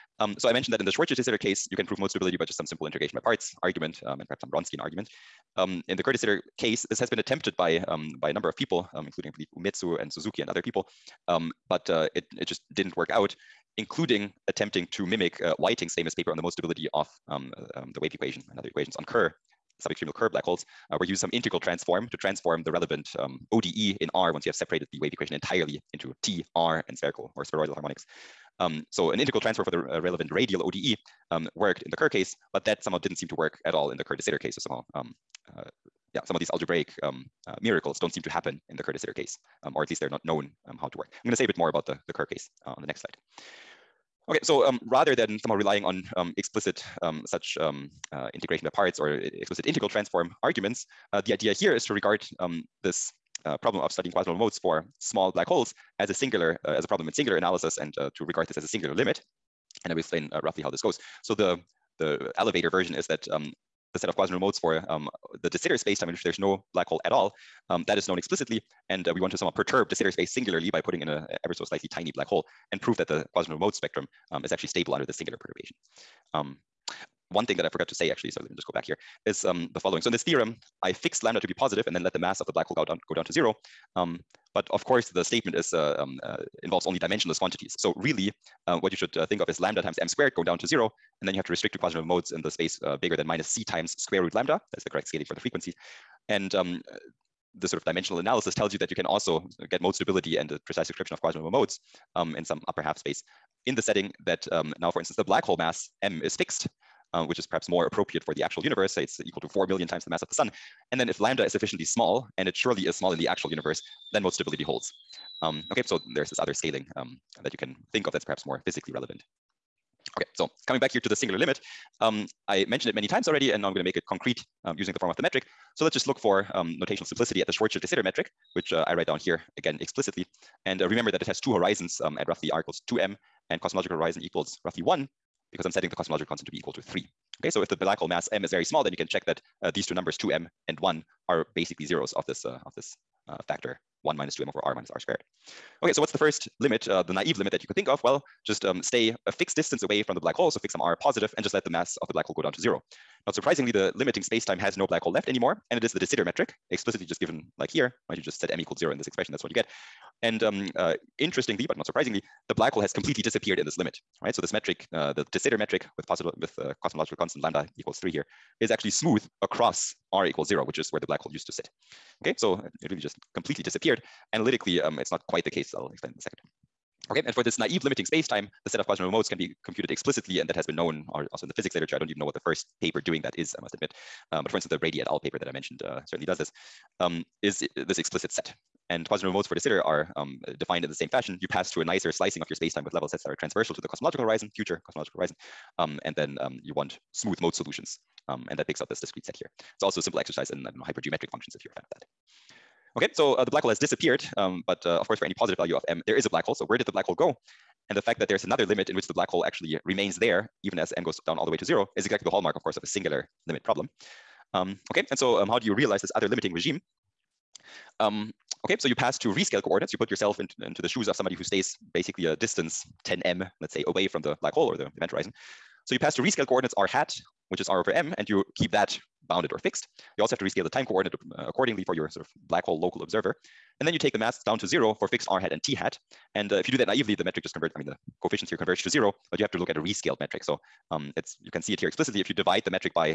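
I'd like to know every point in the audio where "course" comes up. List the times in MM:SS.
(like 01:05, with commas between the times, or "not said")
01:24, 03:25, 03:32.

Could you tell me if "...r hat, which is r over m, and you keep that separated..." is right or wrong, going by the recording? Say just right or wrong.
wrong.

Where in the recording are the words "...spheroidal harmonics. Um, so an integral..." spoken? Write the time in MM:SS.
00:27.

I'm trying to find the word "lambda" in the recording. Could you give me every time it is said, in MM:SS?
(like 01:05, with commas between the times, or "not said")
01:21, 01:29, 01:34, 01:51, 02:47.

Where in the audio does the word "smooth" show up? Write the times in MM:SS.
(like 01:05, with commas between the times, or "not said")
02:48, 03:17.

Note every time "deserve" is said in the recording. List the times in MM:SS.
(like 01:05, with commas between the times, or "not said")
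not said.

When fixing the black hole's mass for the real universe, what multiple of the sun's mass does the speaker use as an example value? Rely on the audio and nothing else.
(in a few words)
4 million.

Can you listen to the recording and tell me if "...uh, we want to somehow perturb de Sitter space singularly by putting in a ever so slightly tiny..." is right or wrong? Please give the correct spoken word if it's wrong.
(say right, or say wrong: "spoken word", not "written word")
right.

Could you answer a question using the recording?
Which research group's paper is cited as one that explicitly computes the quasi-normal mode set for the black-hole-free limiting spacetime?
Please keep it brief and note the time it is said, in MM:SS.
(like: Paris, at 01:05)
Brady et al., at 03:04.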